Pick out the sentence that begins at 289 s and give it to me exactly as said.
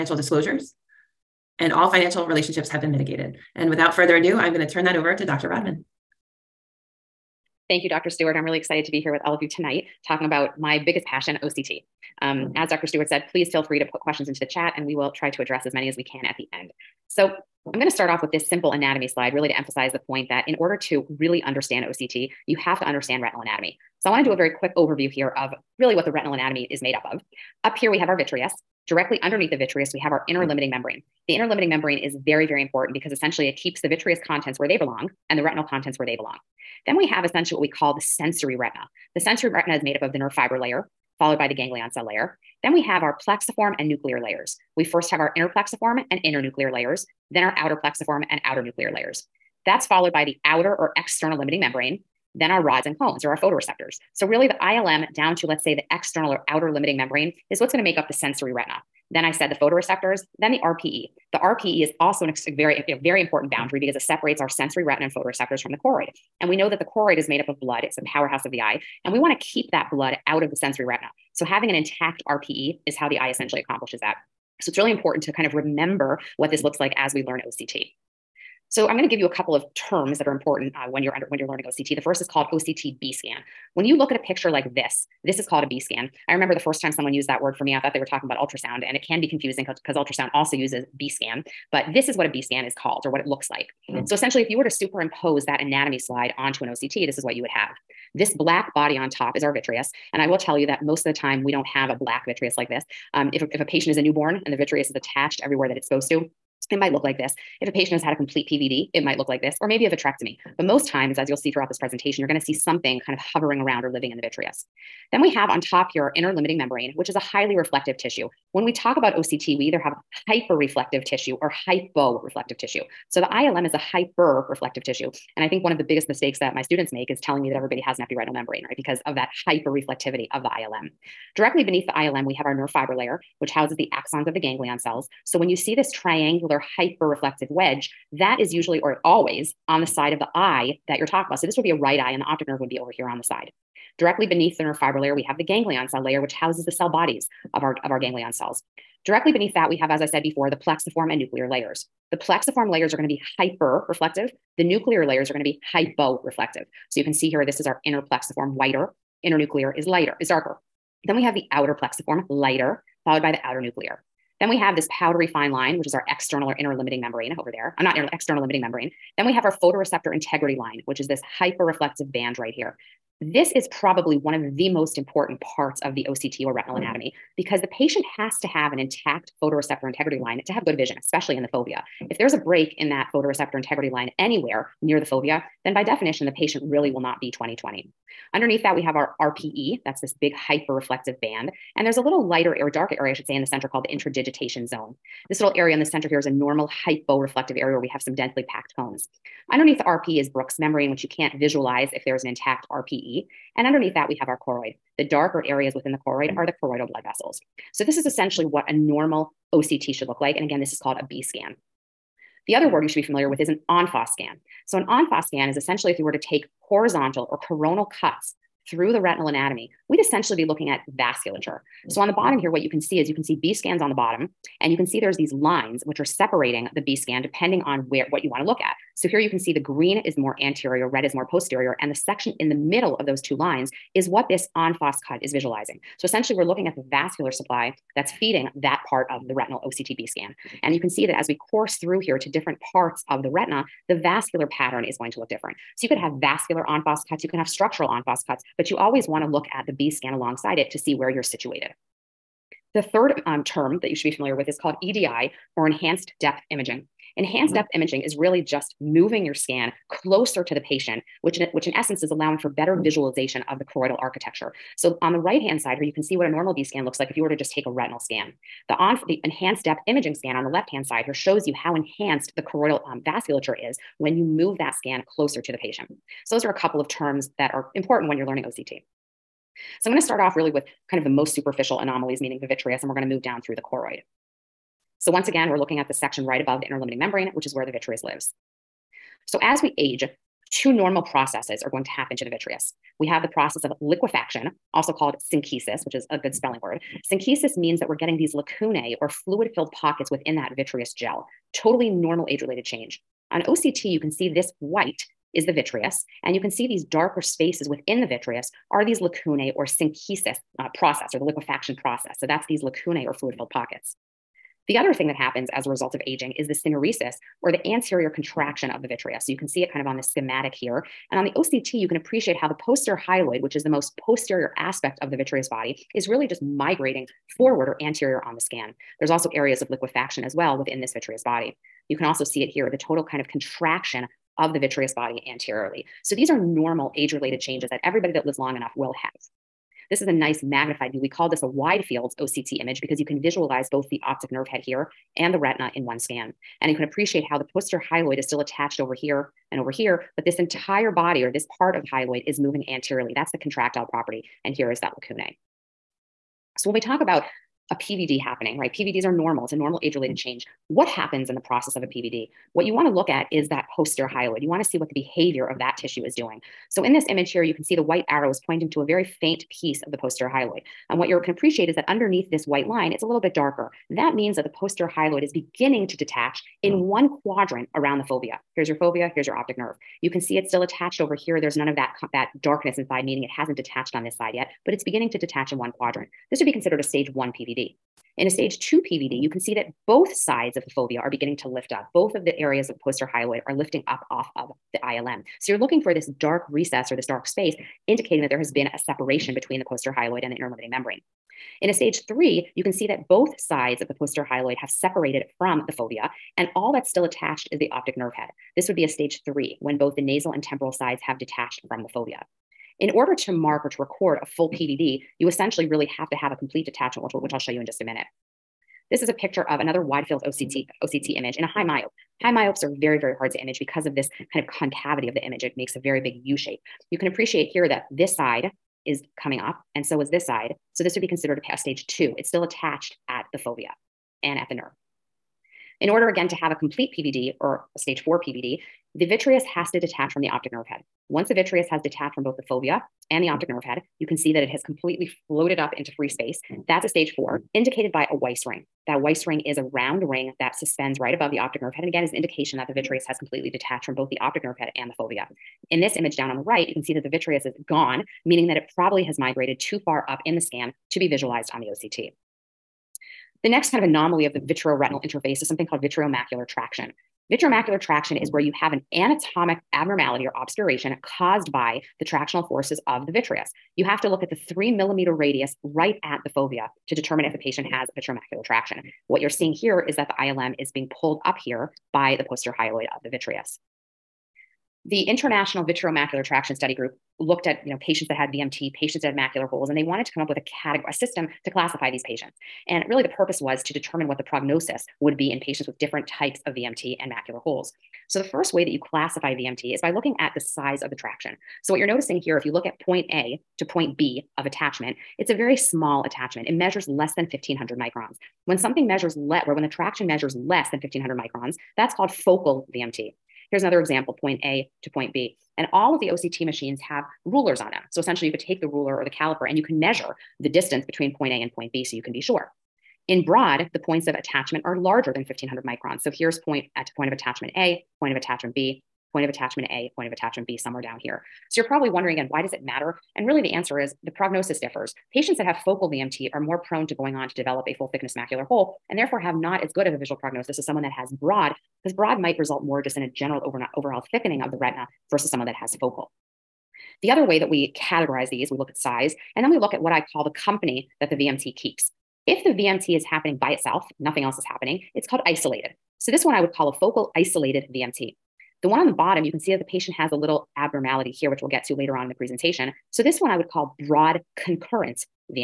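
So as we age, two normal processes are going to happen to the vitreous.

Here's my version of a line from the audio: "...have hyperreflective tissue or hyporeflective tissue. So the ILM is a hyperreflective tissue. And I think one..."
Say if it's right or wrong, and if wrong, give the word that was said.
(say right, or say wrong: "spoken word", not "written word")
right.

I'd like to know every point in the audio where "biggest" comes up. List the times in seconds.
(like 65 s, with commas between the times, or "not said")
10 s, 125 s.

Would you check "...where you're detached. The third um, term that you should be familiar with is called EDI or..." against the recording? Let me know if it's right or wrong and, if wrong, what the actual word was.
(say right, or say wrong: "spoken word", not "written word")
wrong: "situated", not "detached".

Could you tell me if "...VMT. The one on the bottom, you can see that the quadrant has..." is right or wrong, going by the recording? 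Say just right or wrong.
wrong.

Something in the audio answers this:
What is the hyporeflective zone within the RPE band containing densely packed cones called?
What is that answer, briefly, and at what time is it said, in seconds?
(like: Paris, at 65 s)
Interdigitation zone, at 193 s.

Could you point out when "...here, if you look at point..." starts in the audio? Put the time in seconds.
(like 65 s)
502 s.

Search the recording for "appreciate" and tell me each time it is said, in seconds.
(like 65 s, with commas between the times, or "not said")
321 s, 346 s, 371 s, 427 s.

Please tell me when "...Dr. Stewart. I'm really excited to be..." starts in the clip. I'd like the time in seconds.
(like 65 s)
7 s.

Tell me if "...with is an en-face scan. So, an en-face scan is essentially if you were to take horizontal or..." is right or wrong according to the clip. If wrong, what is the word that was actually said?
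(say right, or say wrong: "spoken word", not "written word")
right.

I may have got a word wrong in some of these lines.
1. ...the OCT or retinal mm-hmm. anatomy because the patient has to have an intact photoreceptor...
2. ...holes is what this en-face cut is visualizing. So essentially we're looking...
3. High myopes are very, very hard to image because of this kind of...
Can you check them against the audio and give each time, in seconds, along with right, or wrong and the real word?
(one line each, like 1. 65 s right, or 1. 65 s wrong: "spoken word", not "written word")
1. 175 s right
2. 233 s wrong: "lines", not "holes"
3. 422 s right.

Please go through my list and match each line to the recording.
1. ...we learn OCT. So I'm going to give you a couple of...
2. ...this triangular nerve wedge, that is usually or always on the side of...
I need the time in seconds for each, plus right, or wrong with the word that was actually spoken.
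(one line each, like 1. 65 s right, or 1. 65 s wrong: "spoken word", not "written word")
1. 77 s right
2. 135 s wrong: "hyperreflective", not "nerve".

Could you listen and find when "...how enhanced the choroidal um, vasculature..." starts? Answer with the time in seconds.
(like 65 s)
271 s.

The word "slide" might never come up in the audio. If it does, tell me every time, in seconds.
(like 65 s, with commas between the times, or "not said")
19 s, 95 s.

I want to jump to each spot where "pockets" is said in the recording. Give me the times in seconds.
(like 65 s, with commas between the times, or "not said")
299 s, 313 s.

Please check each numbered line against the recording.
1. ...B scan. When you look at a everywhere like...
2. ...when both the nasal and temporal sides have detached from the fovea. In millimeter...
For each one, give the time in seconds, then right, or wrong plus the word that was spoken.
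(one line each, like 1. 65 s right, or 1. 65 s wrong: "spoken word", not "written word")
1. 83 s wrong: "picture", not "everywhere"
2. 409 s wrong: "order", not "millimeter".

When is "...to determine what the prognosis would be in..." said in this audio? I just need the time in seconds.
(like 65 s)
493 s.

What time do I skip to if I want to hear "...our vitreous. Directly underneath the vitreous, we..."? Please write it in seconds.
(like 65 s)
28 s.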